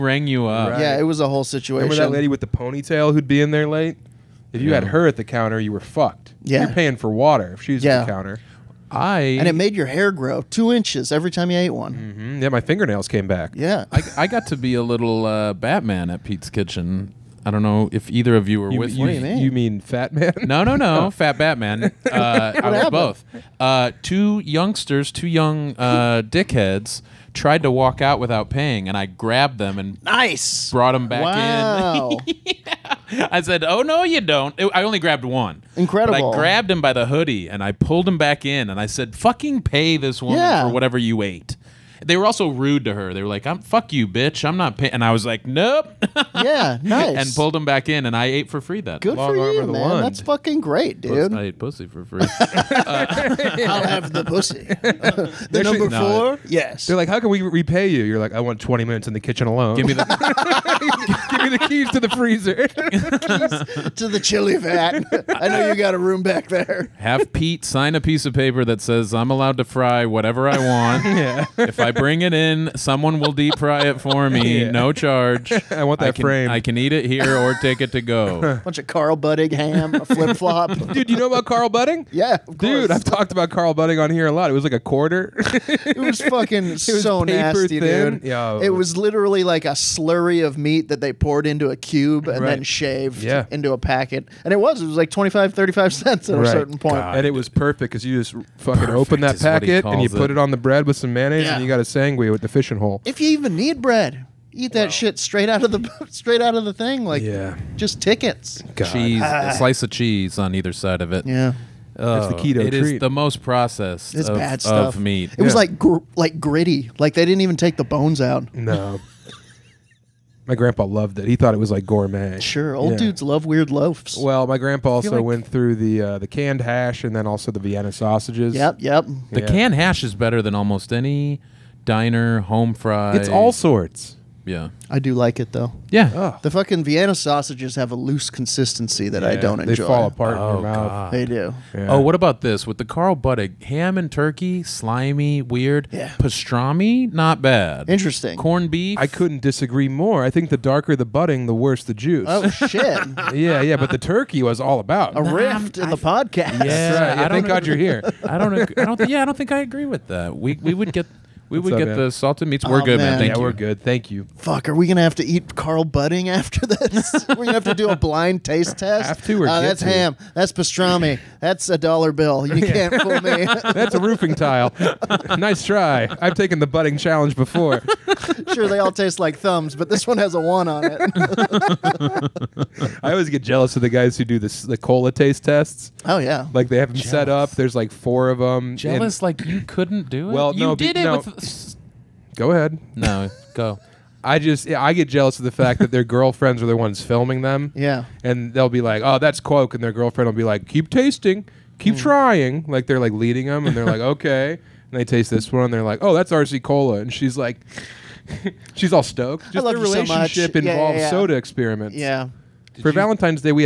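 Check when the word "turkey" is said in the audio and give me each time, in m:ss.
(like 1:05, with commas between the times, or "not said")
2:24, 2:33.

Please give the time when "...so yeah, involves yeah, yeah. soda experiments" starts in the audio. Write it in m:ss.
3:30.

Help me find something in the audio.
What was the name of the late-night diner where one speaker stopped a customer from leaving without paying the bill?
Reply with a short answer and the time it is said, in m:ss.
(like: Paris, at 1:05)
Pete's Kitchen, at 0:16.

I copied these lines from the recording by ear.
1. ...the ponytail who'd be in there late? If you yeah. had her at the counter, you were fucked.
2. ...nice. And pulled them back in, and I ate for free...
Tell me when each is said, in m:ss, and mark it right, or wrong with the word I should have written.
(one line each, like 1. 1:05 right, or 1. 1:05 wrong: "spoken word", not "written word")
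1. 0:02 right
2. 0:46 right.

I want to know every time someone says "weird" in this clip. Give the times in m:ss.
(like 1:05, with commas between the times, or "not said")
2:03, 2:25.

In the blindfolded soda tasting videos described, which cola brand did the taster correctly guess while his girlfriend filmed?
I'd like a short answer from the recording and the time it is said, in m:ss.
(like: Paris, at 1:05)
RC Cola, at 3:26.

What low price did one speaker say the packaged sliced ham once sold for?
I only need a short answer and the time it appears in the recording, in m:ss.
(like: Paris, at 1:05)
25 35 cents, at 1:35.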